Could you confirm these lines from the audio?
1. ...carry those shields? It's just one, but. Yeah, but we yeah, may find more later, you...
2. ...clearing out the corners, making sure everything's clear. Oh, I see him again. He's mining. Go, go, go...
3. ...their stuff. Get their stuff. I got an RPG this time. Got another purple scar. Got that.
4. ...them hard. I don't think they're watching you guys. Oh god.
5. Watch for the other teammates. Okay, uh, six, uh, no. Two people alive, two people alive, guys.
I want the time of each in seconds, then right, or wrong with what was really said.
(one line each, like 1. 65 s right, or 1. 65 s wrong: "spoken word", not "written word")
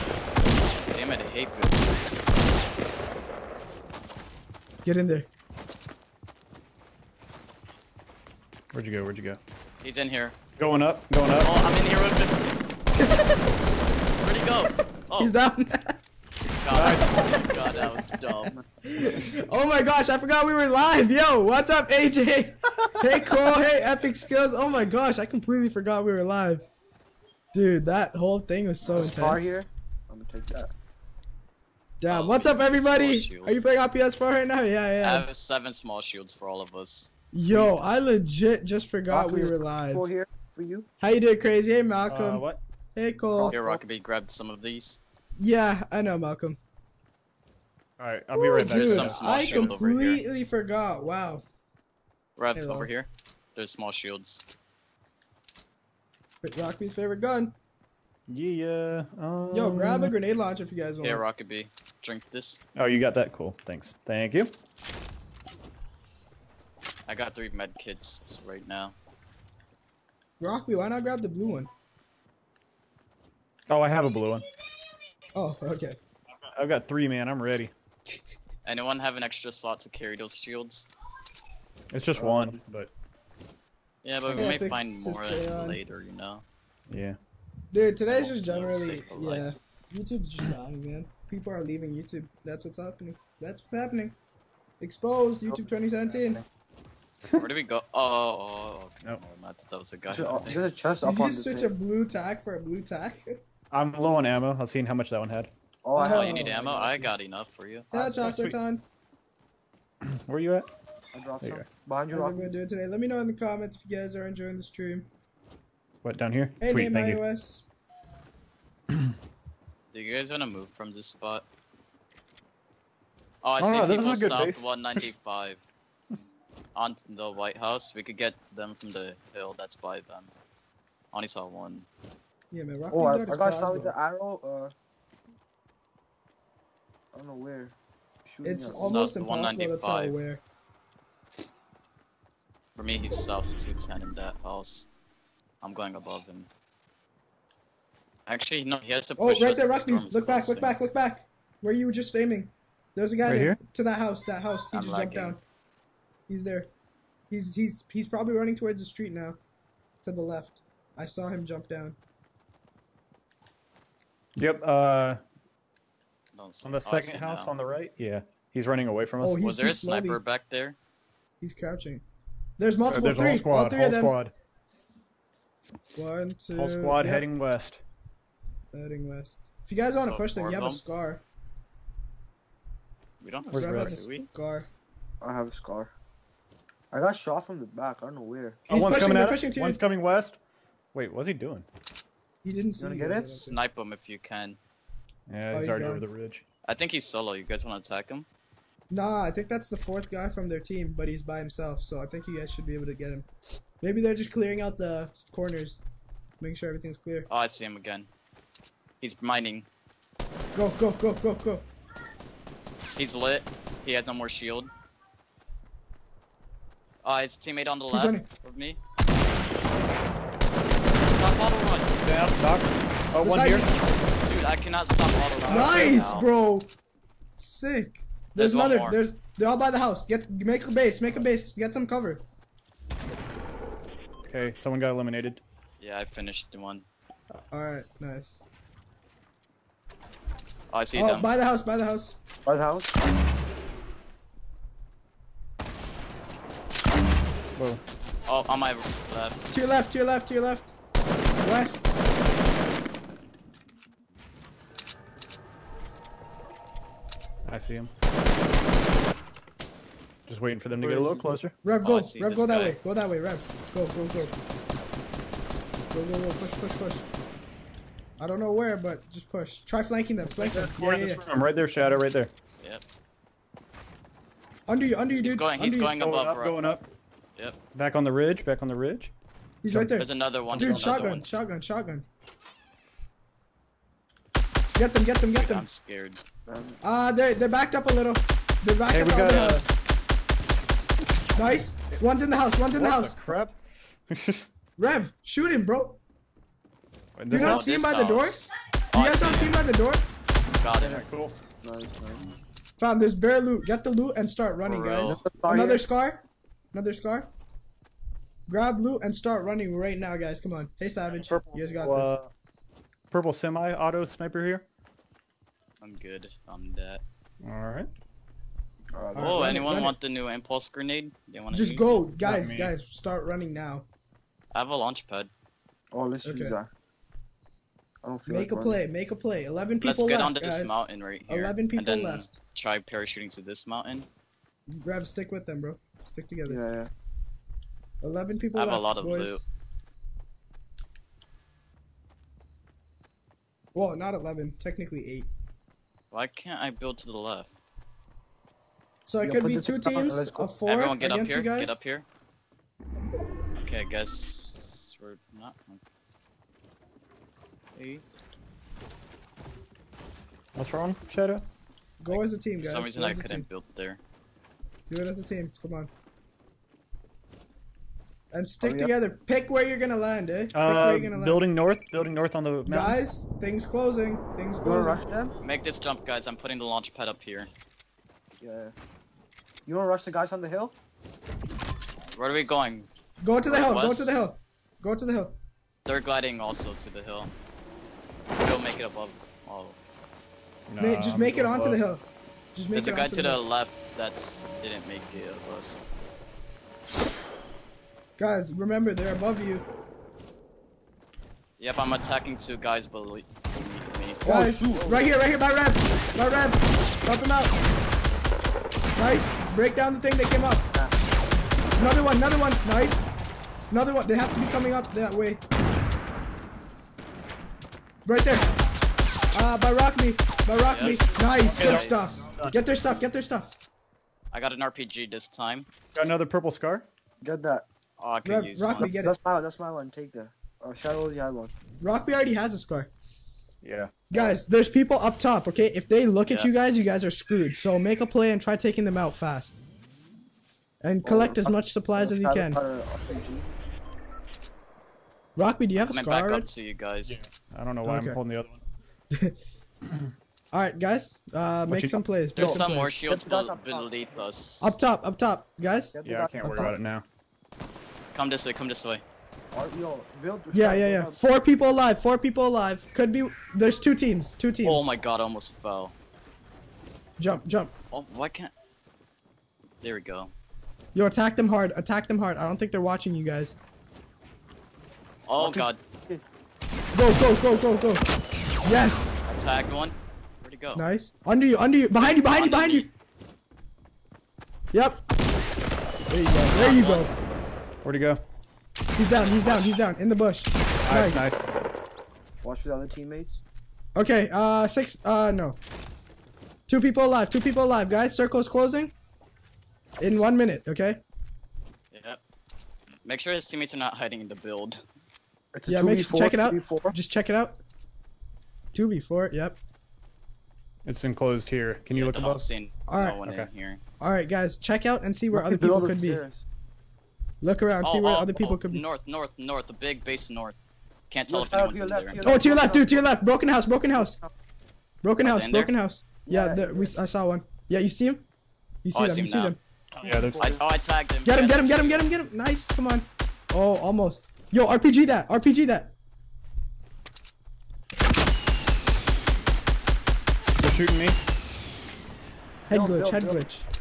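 1. 79 s right
2. 204 s right
3. 422 s right
4. 472 s right
5. 492 s right.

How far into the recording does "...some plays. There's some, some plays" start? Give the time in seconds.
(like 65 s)
451 s.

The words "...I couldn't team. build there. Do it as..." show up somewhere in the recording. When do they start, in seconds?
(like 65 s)
363 s.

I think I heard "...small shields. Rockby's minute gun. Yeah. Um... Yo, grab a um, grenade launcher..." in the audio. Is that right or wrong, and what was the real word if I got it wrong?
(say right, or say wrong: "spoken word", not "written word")
wrong: "favorite", not "minute".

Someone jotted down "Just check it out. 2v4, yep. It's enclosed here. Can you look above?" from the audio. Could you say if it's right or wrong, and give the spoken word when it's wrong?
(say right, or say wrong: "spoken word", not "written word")
right.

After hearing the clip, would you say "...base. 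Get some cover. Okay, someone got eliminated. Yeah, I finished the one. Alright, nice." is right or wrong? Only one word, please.
right.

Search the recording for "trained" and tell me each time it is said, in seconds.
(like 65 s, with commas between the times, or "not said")
not said.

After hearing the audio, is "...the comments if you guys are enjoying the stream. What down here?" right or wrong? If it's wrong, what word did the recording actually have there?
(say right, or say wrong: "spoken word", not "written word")
right.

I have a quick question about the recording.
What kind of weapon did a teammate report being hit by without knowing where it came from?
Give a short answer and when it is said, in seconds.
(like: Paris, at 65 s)
Arrow, at 133 s.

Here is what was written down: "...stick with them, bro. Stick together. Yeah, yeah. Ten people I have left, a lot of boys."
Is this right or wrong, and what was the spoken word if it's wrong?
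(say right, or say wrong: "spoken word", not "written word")
wrong: "Eleven", not "Ten".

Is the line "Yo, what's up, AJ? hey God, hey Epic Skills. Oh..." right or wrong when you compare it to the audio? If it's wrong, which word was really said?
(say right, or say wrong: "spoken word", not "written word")
wrong: "Cole", not "God".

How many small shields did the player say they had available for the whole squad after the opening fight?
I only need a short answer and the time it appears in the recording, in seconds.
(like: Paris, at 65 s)
7, at 35 s.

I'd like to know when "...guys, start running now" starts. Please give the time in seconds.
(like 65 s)
322 s.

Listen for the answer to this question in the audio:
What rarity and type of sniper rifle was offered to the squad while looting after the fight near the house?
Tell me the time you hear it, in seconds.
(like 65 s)
313 s.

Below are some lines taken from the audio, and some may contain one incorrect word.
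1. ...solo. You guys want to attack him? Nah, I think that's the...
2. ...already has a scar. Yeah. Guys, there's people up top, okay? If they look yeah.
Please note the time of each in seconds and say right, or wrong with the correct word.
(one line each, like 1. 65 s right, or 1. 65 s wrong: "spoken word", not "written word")
1. 197 s right
2. 432 s right.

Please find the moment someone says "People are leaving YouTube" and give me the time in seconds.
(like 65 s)
91 s.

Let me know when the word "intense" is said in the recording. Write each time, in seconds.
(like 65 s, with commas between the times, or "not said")
28 s.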